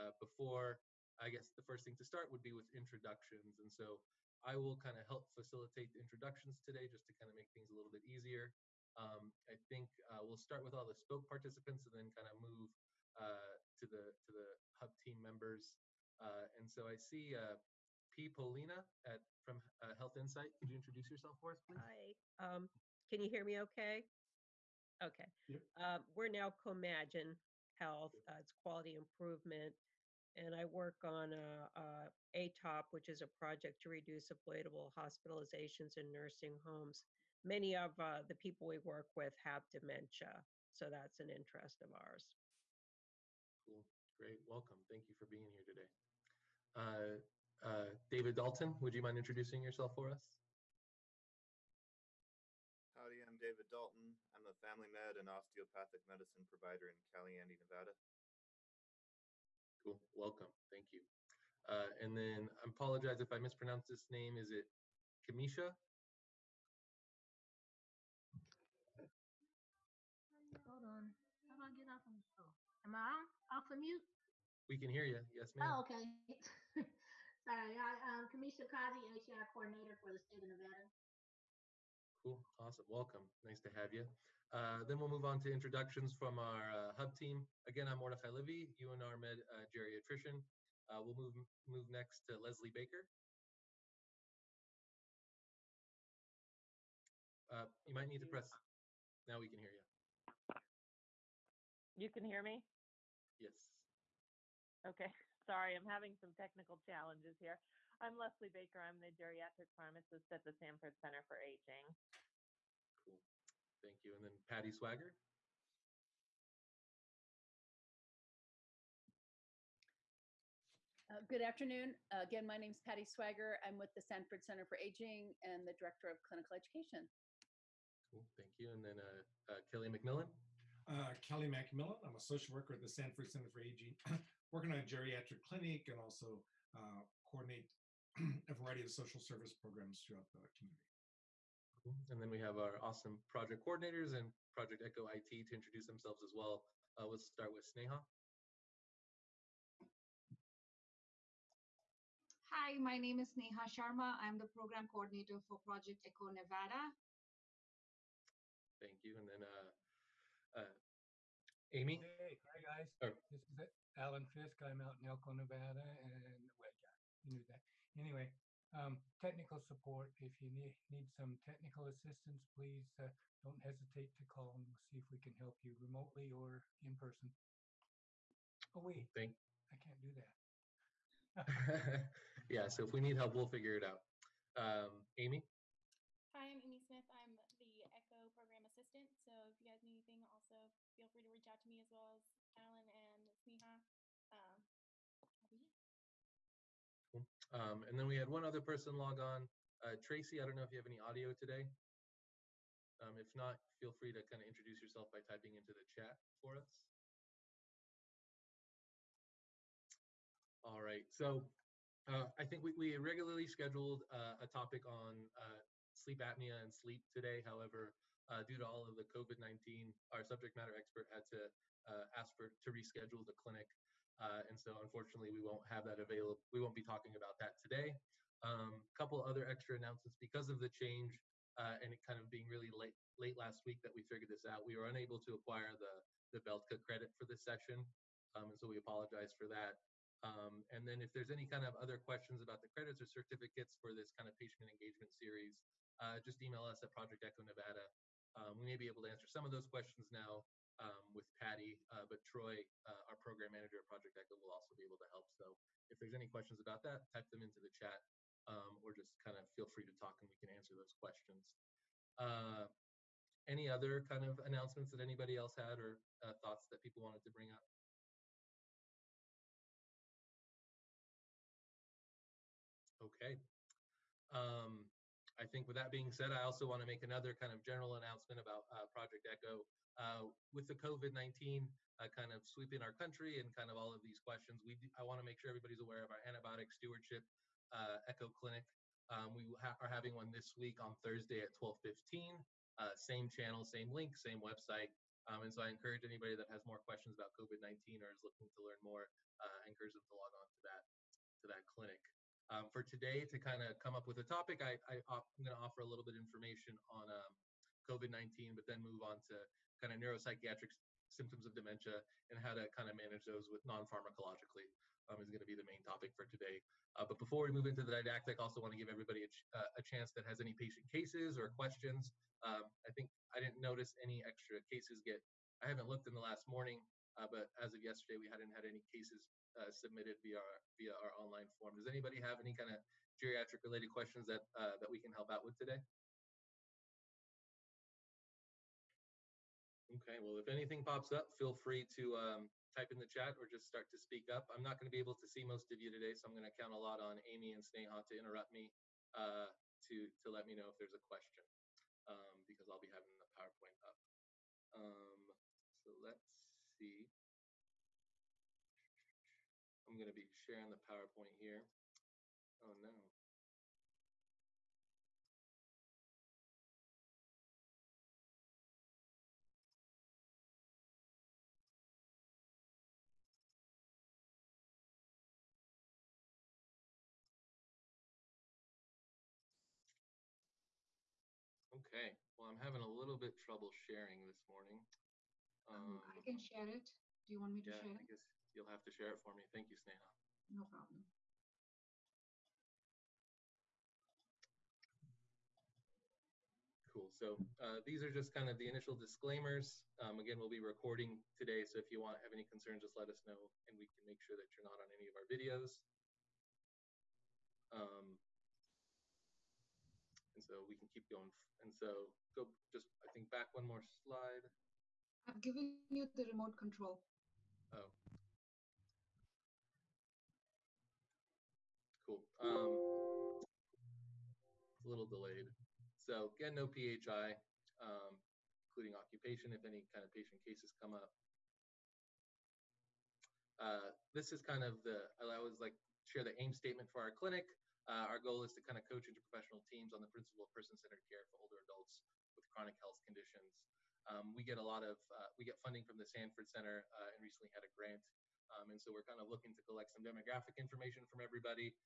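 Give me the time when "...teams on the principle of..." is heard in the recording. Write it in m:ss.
7:19.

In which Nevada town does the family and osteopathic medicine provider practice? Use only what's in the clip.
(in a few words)
Caliente.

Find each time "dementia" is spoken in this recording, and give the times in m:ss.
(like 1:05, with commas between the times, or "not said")
0:39, 5:11.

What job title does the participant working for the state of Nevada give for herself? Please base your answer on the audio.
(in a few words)
HR coordinator.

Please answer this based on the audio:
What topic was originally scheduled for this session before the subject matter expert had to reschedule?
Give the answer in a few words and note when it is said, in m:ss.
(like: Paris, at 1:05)
sleep apnea, at 3:35.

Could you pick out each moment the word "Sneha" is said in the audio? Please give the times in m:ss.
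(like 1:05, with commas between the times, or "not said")
2:27, 3:13, 5:47, 6:29.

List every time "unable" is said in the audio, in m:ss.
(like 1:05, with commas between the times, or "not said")
3:54.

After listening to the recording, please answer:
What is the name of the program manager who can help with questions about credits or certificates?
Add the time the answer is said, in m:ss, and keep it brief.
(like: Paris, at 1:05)
Troy, at 4:12.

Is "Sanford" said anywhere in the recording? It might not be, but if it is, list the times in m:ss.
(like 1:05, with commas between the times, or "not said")
1:50, 2:04, 2:12, 7:26.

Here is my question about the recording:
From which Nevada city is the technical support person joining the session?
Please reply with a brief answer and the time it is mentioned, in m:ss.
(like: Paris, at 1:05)
Elko, at 2:45.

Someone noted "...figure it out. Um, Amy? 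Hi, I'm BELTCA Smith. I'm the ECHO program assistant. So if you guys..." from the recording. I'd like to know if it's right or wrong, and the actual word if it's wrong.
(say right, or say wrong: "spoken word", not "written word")
wrong: "Amy", not "BELTCA".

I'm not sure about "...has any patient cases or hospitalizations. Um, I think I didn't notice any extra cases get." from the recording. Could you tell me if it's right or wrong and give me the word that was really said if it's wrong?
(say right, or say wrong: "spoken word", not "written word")
wrong: "questions", not "hospitalizations".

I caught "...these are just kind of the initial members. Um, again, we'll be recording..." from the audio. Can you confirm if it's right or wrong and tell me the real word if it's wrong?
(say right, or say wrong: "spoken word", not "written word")
wrong: "disclaimers", not "members".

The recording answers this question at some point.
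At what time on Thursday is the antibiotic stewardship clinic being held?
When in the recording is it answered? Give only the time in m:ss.
4:51.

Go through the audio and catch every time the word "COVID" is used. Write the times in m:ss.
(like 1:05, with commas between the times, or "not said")
3:39, 4:40, 4:57, 5:07.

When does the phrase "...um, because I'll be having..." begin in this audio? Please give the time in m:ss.
5:52.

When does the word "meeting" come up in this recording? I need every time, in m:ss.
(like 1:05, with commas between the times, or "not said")
not said.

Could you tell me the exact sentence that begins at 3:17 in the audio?
Um, um, and then we had one other person log on.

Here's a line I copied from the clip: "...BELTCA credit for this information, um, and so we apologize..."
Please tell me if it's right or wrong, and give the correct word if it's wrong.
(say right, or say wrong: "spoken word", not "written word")
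wrong: "session", not "information".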